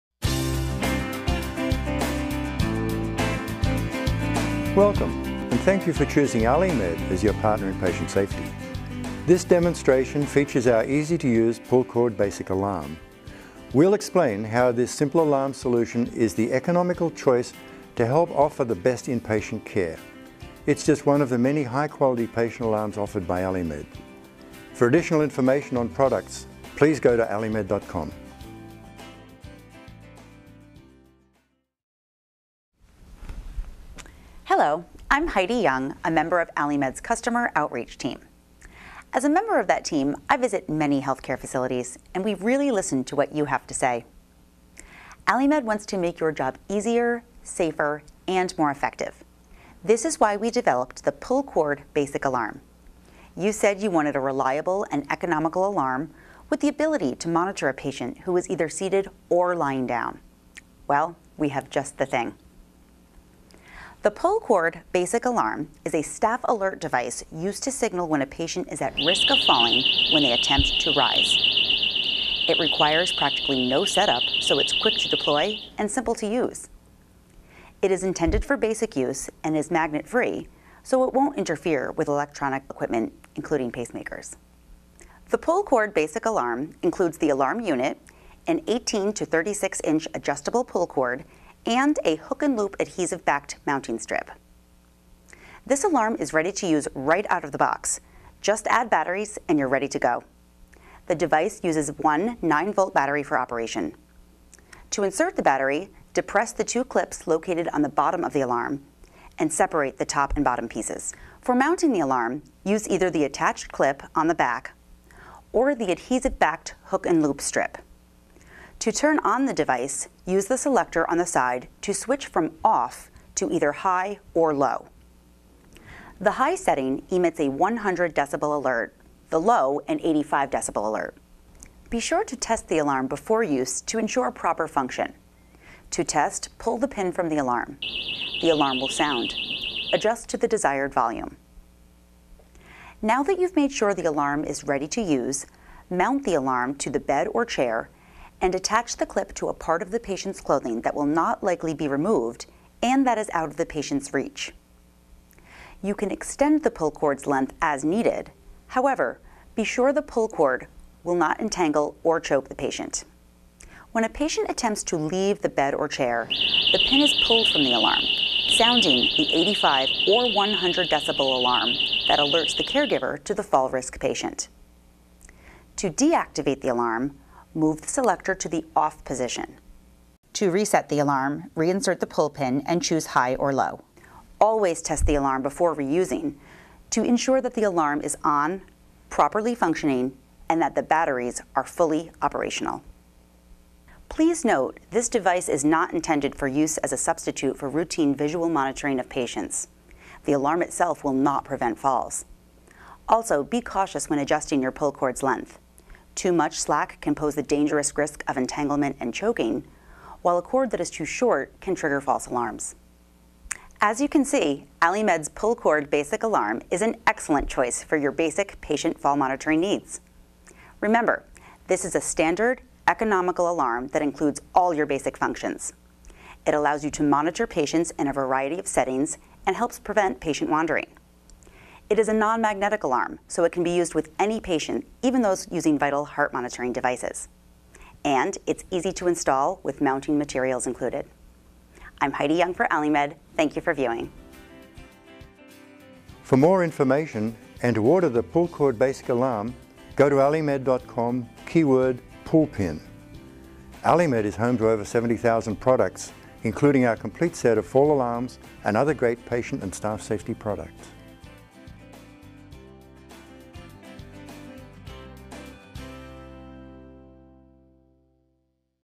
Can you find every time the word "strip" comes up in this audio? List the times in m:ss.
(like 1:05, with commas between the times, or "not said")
1:33, 1:57.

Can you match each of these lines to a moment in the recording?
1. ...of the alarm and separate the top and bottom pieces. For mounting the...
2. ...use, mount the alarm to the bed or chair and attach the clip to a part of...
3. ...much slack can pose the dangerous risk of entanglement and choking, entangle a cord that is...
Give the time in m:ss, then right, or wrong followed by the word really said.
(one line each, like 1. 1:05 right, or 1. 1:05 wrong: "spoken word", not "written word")
1. 1:48 right
2. 2:25 right
3. 3:26 wrong: "while", not "entangle".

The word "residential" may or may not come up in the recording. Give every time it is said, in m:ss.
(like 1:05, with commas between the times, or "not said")
not said.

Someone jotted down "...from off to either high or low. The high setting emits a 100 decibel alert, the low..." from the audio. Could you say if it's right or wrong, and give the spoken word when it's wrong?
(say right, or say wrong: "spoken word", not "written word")
right.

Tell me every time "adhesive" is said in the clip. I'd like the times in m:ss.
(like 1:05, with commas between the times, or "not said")
1:32, 1:55.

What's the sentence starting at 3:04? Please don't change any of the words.
Always test the alarm before reusing to ensure that the alarm is on, properly functioning, and that the batteries are fully operational.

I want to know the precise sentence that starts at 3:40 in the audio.
Remember, this is a standard, economical alarm that includes all your basic functions.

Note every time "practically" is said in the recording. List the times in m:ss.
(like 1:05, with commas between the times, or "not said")
1:13.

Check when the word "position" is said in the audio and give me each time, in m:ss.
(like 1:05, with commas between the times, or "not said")
2:59.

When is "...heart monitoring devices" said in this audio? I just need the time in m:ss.
3:56.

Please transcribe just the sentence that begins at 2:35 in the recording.
You can extend the pull cord's length as needed.